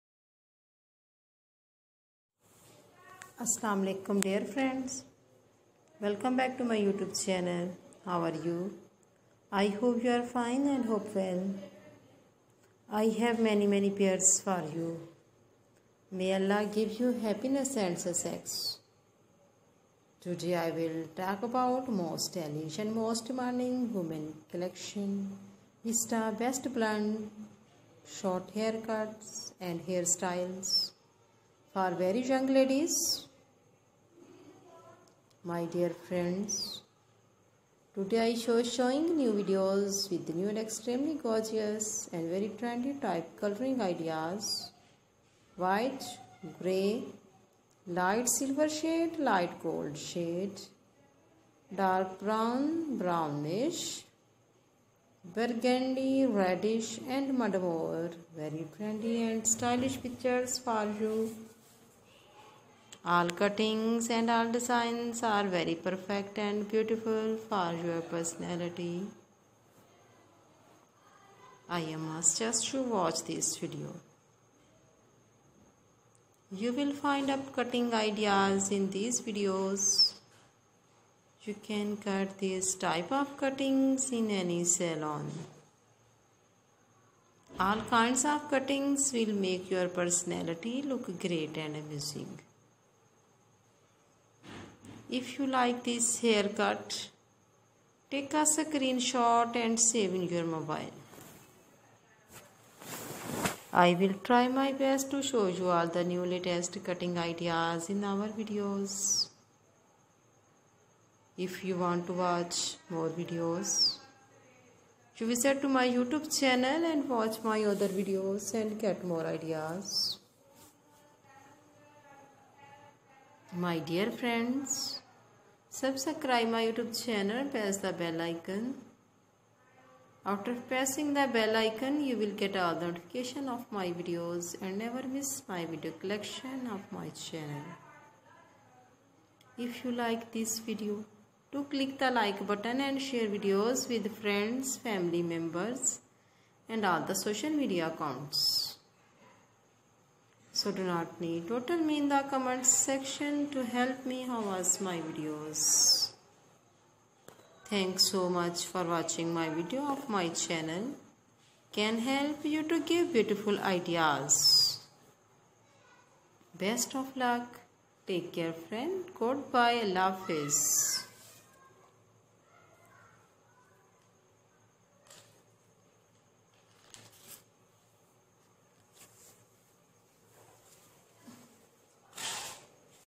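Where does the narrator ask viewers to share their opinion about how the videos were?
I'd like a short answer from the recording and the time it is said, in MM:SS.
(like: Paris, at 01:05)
Comment section, at 02:32.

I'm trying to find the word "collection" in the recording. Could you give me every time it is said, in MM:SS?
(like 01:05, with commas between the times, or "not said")
00:24, 02:15.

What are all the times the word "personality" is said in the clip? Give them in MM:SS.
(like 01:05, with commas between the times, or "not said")
01:08, 01:29.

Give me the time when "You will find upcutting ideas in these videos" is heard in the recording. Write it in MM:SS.
01:16.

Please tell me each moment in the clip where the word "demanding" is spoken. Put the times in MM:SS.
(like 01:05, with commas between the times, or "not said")
00:23.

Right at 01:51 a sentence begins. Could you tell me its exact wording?
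If you want to watch more videos, you visit to my YouTube channel and watch my other videos and get more ideas.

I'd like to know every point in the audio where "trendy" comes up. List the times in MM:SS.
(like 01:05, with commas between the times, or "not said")
00:42, 00:58.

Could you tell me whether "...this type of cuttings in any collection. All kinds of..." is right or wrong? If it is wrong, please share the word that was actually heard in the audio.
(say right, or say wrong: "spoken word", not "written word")
wrong: "salon", not "collection".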